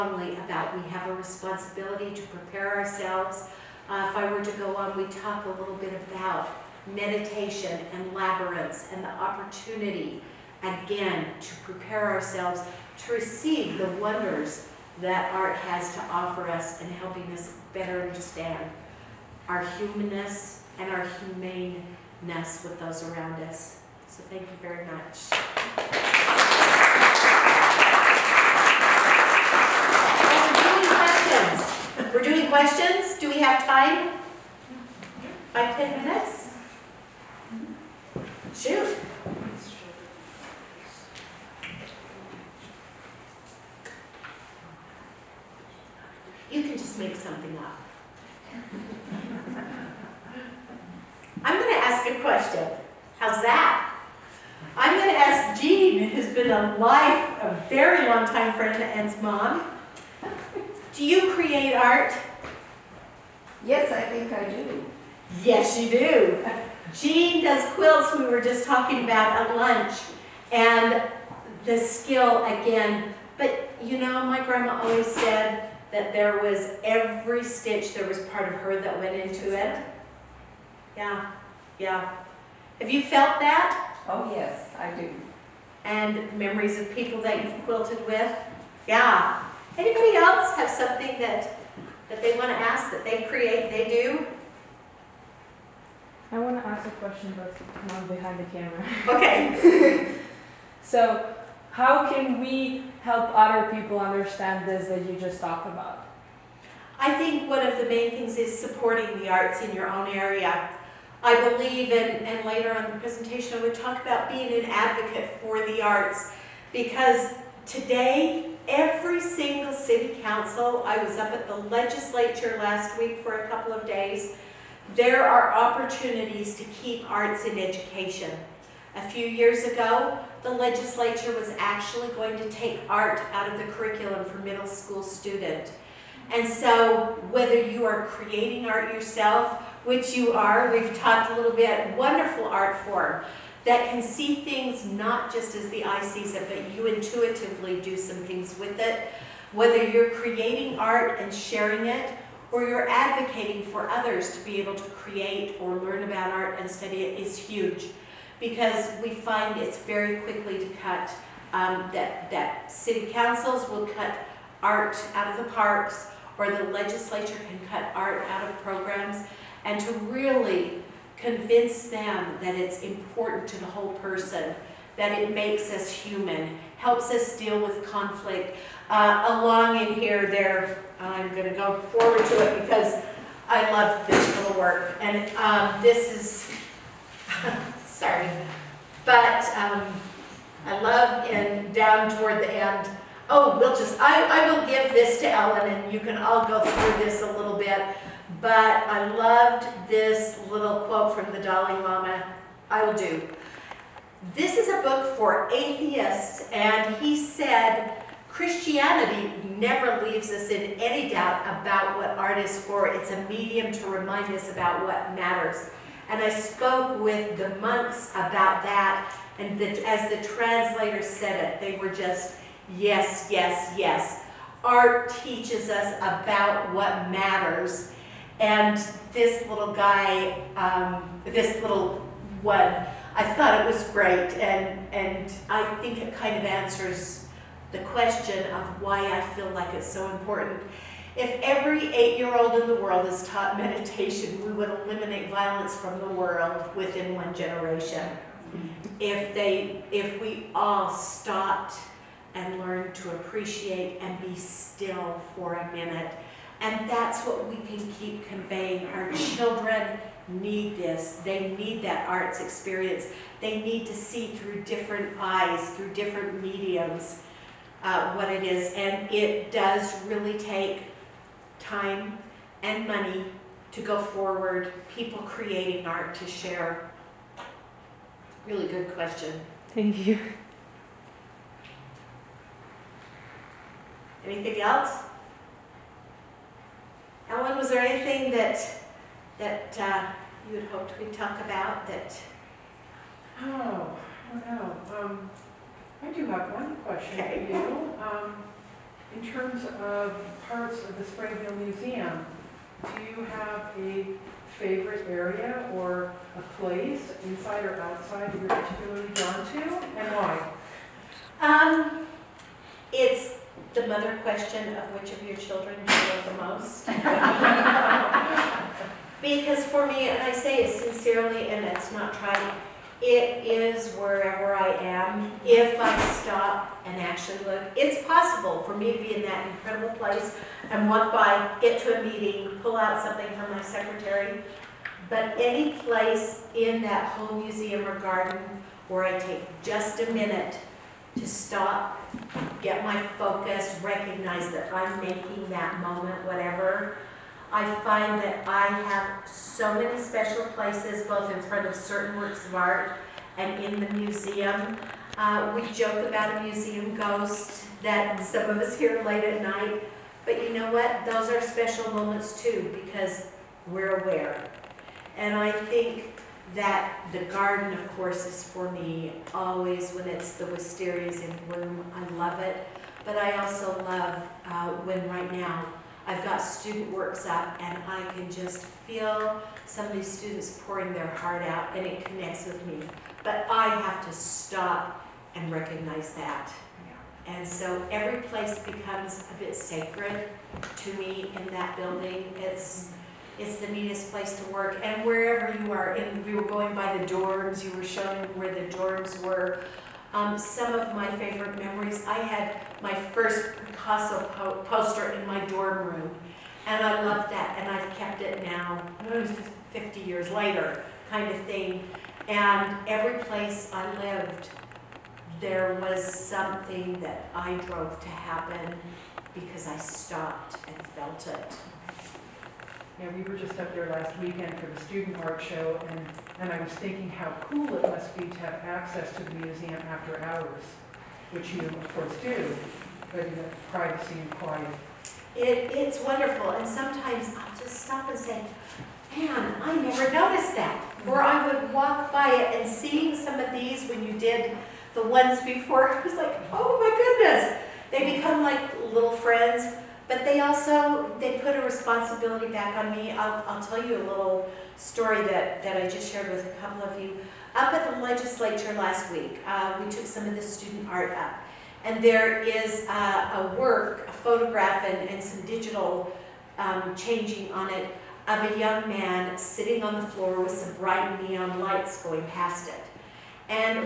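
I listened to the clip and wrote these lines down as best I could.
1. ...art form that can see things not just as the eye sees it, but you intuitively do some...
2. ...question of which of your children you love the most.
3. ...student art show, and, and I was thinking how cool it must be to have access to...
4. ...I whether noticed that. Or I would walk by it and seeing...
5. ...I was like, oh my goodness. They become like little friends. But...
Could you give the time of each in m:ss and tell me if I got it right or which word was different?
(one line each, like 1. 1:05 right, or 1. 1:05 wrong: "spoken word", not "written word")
1. 2:22 right
2. 5:14 right
3. 7:04 right
4. 7:19 wrong: "never", not "whether"
5. 7:25 right.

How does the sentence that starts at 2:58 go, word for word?
Uh, along in here, there, I'm going to go forward to it because I love this little work.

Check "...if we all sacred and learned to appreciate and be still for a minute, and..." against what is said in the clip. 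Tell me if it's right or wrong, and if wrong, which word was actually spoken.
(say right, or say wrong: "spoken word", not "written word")
wrong: "stopped", not "sacred".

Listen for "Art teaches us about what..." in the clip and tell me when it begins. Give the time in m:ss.
3:44.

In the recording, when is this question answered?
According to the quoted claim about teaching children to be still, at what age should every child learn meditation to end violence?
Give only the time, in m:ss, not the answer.
4:01.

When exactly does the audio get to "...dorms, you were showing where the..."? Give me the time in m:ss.
6:37.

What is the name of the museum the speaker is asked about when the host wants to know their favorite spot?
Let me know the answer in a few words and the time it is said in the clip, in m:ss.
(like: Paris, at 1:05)
Springville Museum, at 5:01.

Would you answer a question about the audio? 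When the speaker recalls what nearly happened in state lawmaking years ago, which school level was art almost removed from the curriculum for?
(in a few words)
middle school.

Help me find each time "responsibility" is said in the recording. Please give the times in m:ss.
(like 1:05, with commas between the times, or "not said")
0:01, 7:31.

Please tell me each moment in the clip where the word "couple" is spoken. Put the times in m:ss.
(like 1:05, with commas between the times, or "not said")
2:03, 7:36.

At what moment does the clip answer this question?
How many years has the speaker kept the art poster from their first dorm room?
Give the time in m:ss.
6:49.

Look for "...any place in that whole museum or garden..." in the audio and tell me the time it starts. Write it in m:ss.
5:35.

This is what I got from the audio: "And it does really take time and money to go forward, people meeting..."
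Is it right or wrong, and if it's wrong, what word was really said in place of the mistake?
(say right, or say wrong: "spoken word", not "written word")
wrong: "creating", not "meeting".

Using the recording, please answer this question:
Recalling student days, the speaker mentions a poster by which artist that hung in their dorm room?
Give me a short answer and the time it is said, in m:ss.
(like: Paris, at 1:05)
Picasso, at 6:43.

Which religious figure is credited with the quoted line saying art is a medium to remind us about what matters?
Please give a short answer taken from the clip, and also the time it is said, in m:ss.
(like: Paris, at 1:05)
Dalai Lama, at 3:21.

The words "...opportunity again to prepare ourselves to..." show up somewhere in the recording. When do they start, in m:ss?
0:09.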